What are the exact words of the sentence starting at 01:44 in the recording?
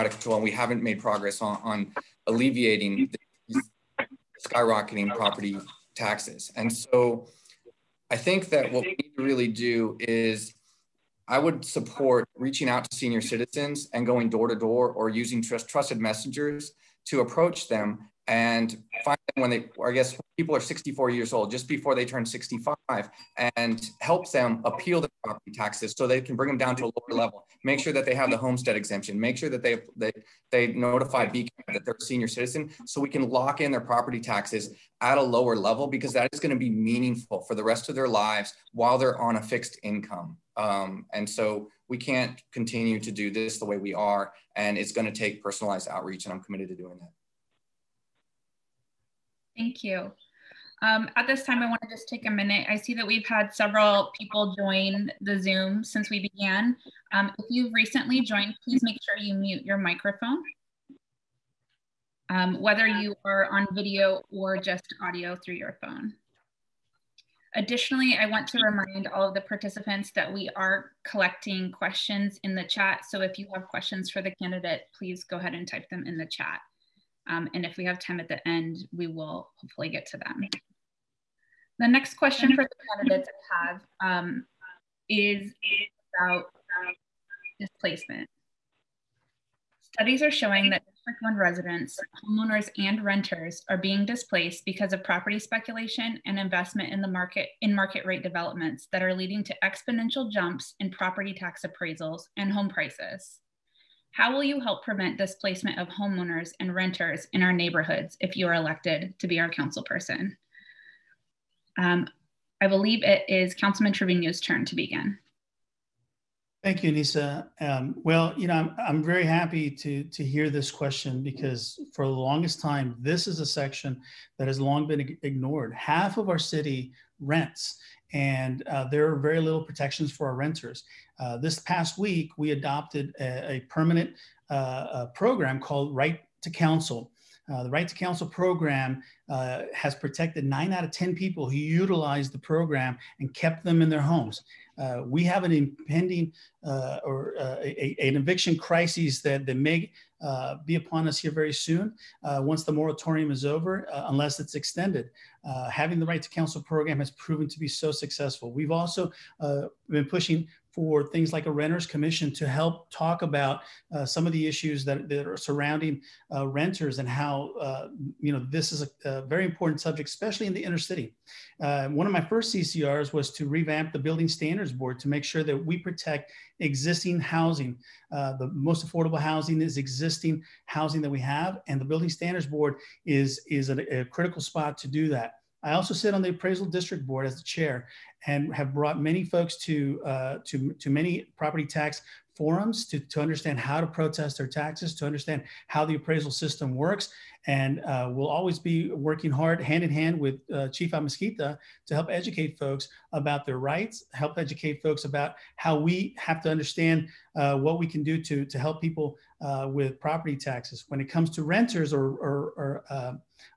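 How will you help prevent displacement of homeowners and renters in our neighborhoods if you are elected to be our council person?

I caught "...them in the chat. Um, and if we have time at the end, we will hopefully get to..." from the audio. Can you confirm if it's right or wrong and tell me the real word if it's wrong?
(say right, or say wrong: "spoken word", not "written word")
right.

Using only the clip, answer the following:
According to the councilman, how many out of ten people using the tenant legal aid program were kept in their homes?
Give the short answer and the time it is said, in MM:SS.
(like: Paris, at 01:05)
9, at 02:20.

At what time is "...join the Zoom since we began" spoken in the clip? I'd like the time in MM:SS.
00:54.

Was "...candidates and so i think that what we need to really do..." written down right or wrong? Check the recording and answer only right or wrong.
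wrong.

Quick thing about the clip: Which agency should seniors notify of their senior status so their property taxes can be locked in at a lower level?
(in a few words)
BCAD.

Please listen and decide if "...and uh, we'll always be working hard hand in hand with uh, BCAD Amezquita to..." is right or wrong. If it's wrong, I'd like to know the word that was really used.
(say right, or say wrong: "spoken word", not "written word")
wrong: "Chief", not "BCAD".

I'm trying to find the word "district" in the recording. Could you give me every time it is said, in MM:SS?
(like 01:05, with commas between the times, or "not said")
01:30, 03:06.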